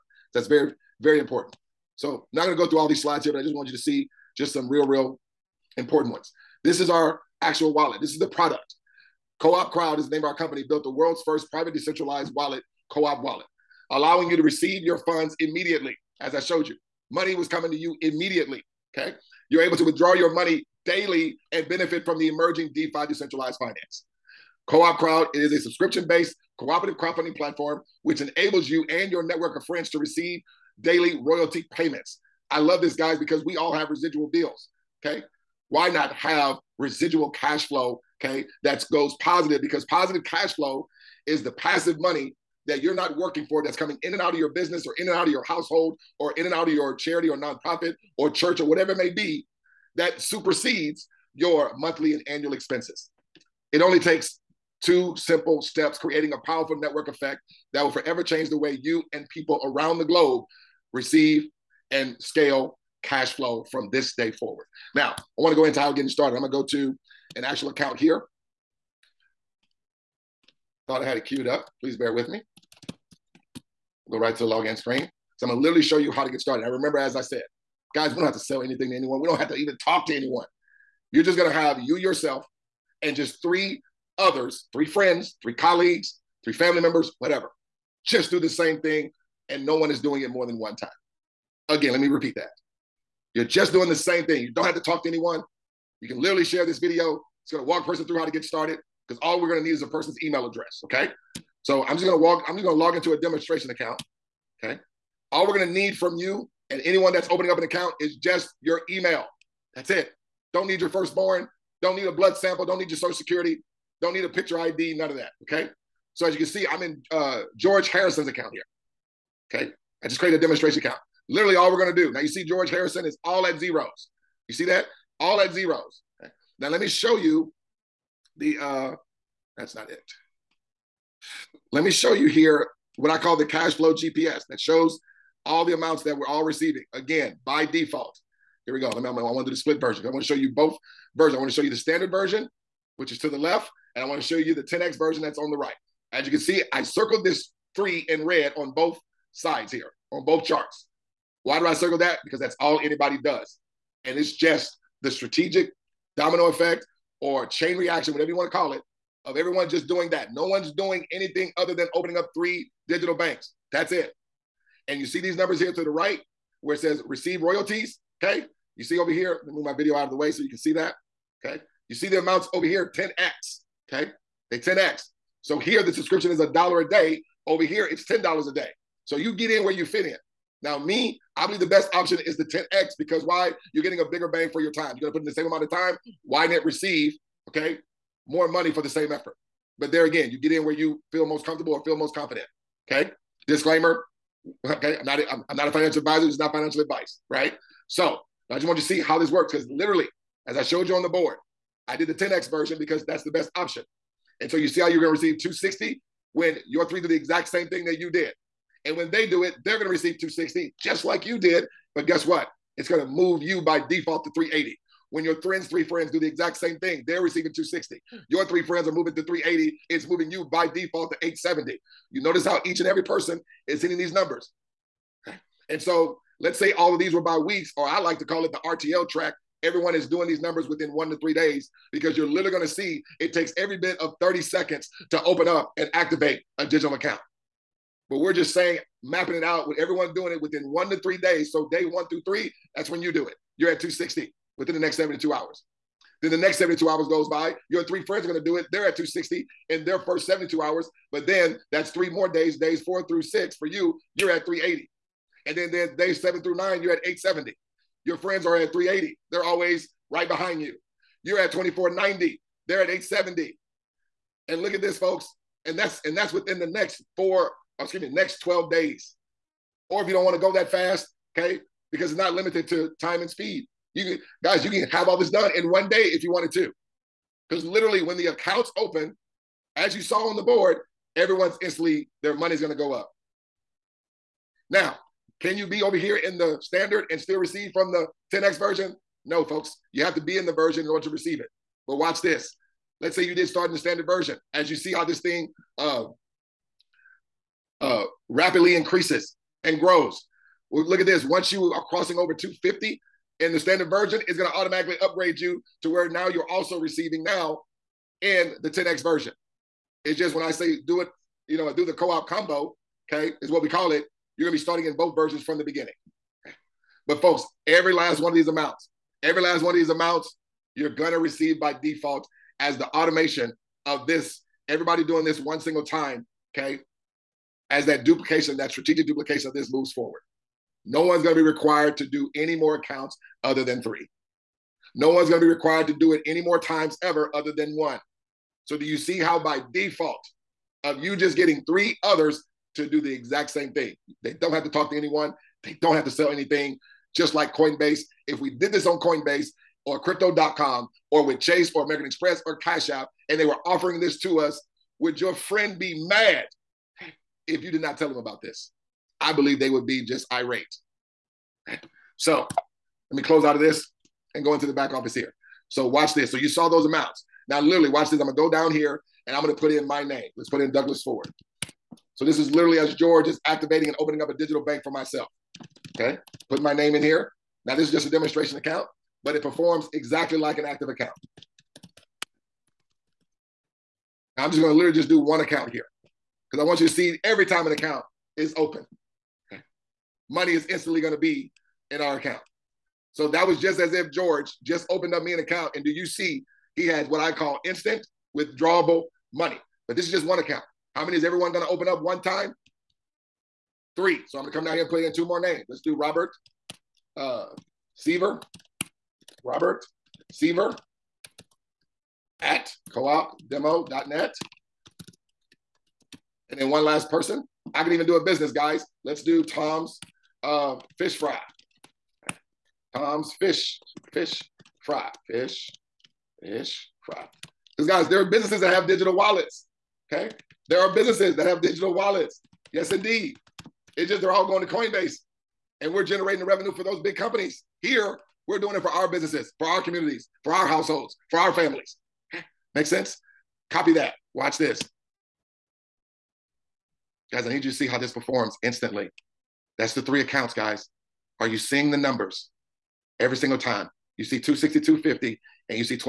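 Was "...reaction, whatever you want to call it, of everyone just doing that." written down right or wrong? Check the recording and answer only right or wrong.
right.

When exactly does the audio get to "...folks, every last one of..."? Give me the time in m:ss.
5:17.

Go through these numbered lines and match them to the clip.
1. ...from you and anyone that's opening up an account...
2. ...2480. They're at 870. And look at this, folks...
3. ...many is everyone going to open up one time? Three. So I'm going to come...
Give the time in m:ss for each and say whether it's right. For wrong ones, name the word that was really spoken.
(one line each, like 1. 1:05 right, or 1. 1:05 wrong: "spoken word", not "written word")
1. 1:45 right
2. 4:21 wrong: "2490", not "2480"
3. 6:41 right.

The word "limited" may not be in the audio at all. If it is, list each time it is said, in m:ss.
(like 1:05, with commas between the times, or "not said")
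4:32.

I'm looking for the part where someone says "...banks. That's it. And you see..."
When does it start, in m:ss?
2:43.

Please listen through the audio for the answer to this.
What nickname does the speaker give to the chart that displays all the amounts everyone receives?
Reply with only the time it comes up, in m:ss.
2:13.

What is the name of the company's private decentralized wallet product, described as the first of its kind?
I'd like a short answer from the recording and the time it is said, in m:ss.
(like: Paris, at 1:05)
Co-op Wallet, at 0:12.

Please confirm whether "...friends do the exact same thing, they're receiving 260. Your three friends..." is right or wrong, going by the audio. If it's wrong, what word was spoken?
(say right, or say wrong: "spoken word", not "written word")
right.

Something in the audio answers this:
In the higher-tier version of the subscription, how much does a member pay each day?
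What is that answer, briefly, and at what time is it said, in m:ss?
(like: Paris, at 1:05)
$10 a day, at 2:58.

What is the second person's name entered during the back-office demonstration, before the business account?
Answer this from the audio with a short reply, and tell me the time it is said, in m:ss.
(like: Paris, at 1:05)
Robert Seaver, at 6:49.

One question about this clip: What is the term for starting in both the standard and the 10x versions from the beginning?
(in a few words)
co-op combo.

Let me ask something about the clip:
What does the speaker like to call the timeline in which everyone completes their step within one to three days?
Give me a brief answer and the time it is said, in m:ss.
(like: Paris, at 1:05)
RTL track, at 3:48.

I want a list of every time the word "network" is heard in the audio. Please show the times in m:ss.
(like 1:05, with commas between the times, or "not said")
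0:29, 0:56.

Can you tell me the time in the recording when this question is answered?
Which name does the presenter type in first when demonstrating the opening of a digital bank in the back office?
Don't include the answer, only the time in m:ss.
6:10.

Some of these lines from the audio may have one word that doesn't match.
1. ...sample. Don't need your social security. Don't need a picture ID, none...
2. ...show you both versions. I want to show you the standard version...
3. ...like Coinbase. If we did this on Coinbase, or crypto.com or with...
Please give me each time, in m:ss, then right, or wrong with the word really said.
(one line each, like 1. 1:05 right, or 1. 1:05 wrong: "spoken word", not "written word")
1. 1:52 right
2. 2:20 right
3. 5:47 right.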